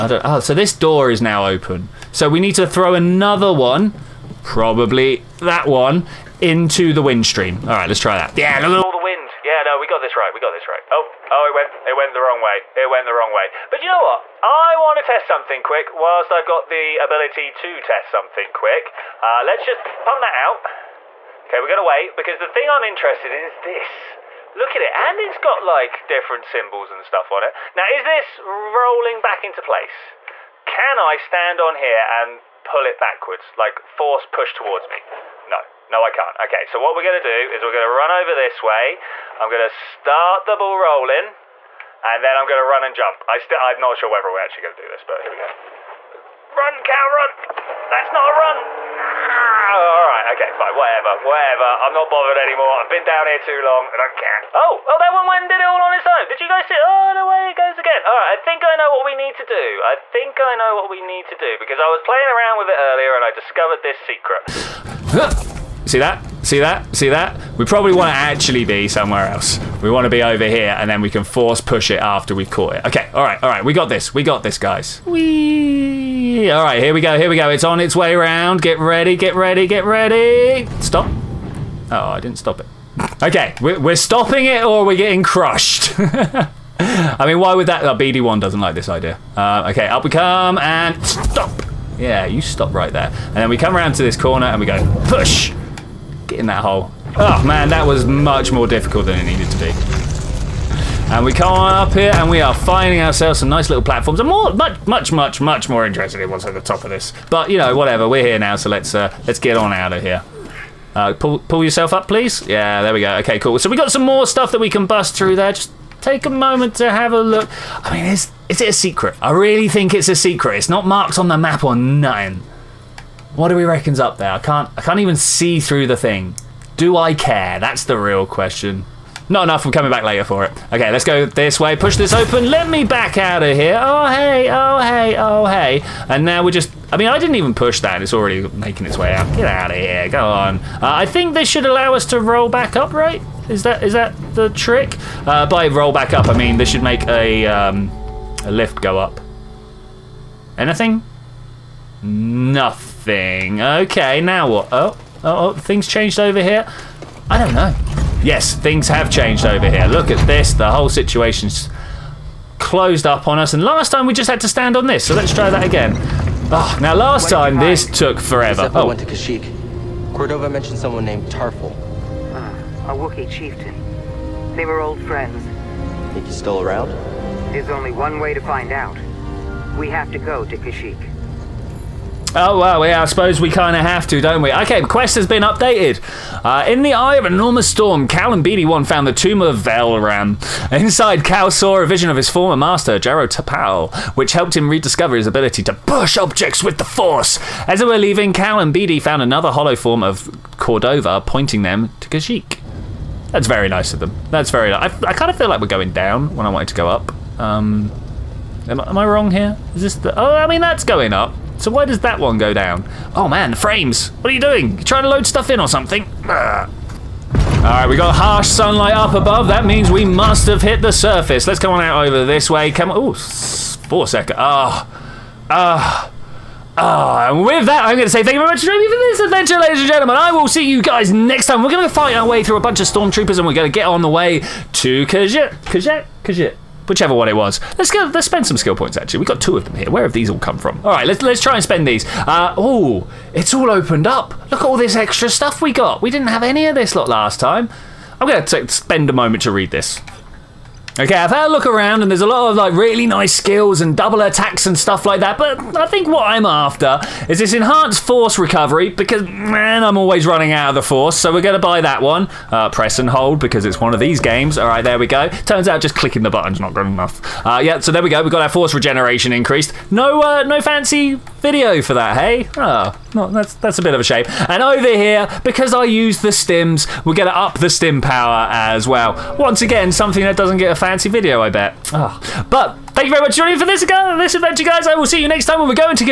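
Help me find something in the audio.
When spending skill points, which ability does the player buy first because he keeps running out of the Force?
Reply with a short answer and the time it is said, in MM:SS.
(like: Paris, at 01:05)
enhanced force recovery, at 04:17.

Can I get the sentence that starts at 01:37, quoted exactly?
Oh man, that was much more difficult than it needed to be.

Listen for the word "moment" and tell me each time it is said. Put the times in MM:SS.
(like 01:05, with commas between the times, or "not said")
01:56, 04:09.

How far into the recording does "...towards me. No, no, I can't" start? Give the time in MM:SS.
00:34.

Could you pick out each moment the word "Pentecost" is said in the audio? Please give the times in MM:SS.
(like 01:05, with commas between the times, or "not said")
not said.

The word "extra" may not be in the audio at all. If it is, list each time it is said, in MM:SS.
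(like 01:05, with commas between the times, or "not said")
04:04.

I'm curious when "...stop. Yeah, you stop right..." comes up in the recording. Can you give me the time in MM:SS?
01:31.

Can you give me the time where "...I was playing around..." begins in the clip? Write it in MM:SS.
01:01.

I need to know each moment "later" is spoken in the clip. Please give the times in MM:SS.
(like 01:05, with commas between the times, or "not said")
02:10.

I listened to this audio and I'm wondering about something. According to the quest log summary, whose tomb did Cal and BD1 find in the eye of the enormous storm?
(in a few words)
Velram.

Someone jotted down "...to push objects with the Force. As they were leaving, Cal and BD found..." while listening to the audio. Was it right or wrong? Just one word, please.
right.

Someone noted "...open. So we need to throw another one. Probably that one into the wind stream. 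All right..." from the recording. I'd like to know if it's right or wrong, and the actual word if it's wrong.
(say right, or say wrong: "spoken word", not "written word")
right.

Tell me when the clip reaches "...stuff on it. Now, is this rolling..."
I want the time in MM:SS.
00:27.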